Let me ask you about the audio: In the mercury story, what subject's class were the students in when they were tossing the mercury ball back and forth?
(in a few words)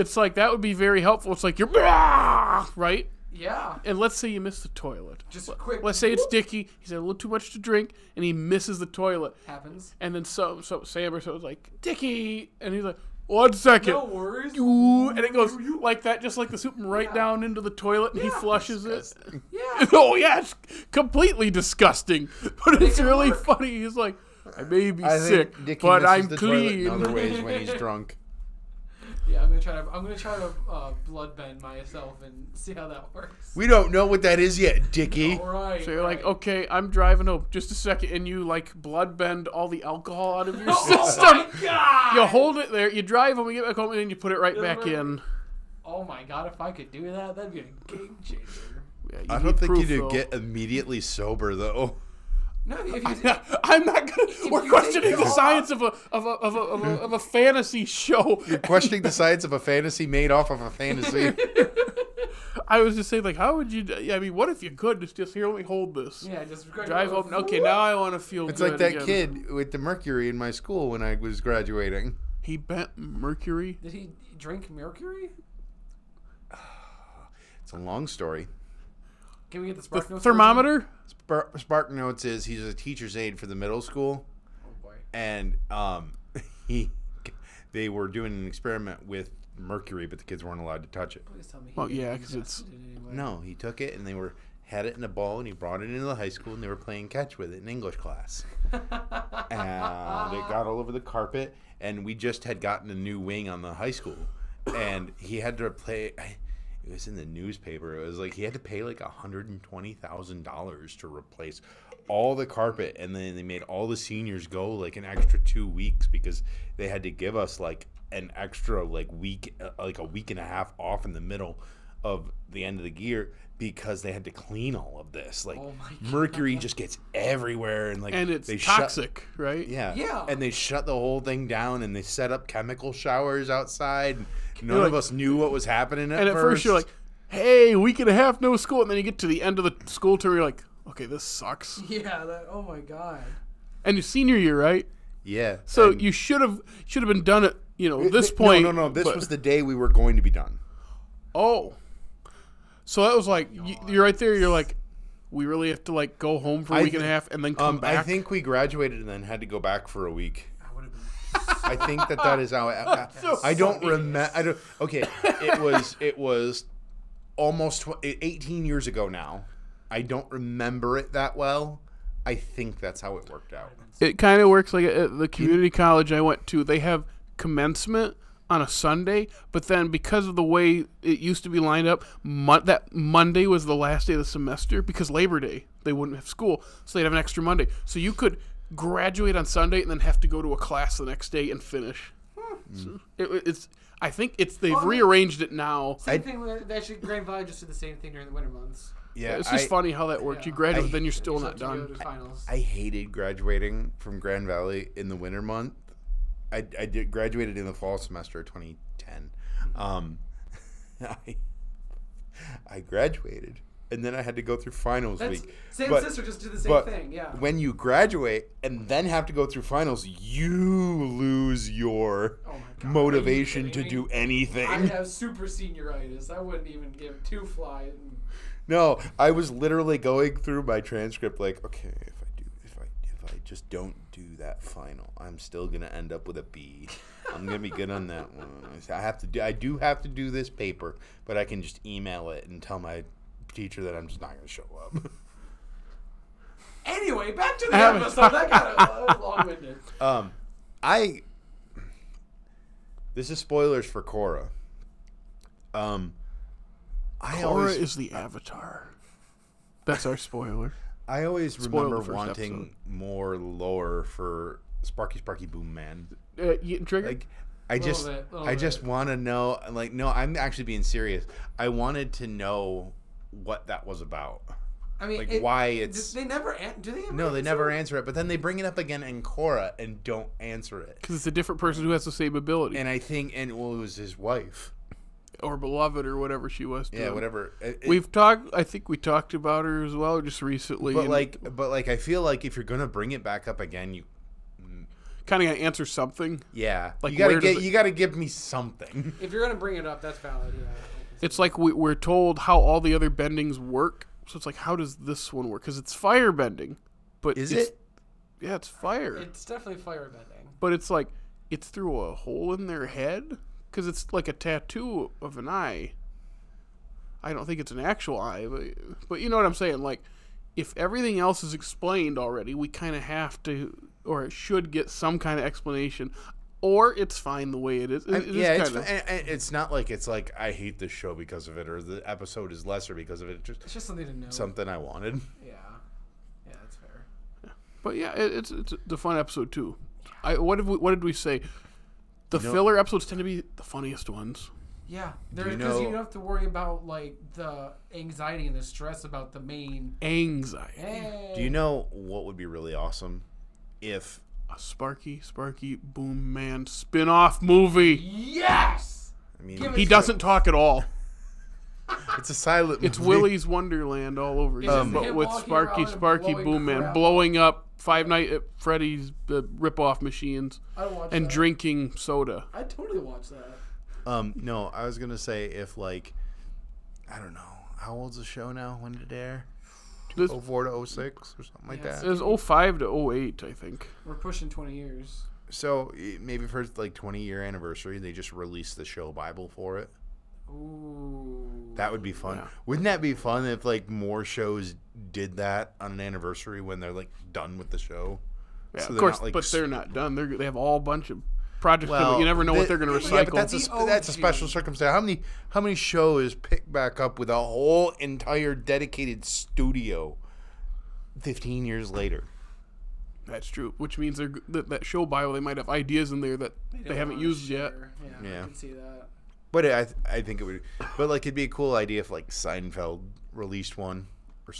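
English.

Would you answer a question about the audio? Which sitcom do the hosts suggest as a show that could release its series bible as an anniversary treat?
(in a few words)
Seinfeld.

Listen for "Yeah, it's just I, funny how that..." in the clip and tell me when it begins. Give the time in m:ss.
3:19.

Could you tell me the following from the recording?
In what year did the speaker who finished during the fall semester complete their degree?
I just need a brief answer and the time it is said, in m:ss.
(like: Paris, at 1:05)
2010, at 3:28.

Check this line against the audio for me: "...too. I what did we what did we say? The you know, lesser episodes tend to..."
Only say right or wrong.
wrong.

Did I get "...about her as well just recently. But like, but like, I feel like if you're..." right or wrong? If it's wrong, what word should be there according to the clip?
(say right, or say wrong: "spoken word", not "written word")
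right.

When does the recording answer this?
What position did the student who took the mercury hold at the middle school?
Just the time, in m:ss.
1:22.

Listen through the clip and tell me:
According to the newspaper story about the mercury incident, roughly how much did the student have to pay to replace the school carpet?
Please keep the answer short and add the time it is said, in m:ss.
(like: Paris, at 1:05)
$120,000, at 1:49.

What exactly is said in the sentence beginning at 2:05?
Like oh mercury just gets everywhere and like and it's they toxic, shut, right?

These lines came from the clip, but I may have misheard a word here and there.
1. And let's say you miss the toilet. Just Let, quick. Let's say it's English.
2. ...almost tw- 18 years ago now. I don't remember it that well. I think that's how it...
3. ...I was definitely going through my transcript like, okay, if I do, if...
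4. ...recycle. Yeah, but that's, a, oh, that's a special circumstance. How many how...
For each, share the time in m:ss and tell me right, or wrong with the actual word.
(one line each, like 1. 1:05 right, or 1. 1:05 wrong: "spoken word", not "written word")
1. 0:03 wrong: "Dickey", not "English"
2. 2:47 right
3. 3:49 wrong: "literally", not "definitely"
4. 6:43 right.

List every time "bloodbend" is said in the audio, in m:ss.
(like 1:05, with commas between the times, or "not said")
0:31, 0:38.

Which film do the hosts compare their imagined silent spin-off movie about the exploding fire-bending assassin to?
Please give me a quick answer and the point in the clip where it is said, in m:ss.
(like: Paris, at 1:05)
Willy's Wonderland, at 6:02.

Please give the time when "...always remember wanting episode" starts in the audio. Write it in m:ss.
4:21.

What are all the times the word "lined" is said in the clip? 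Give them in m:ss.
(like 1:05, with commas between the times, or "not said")
3:01.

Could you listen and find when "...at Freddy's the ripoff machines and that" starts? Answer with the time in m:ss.
6:08.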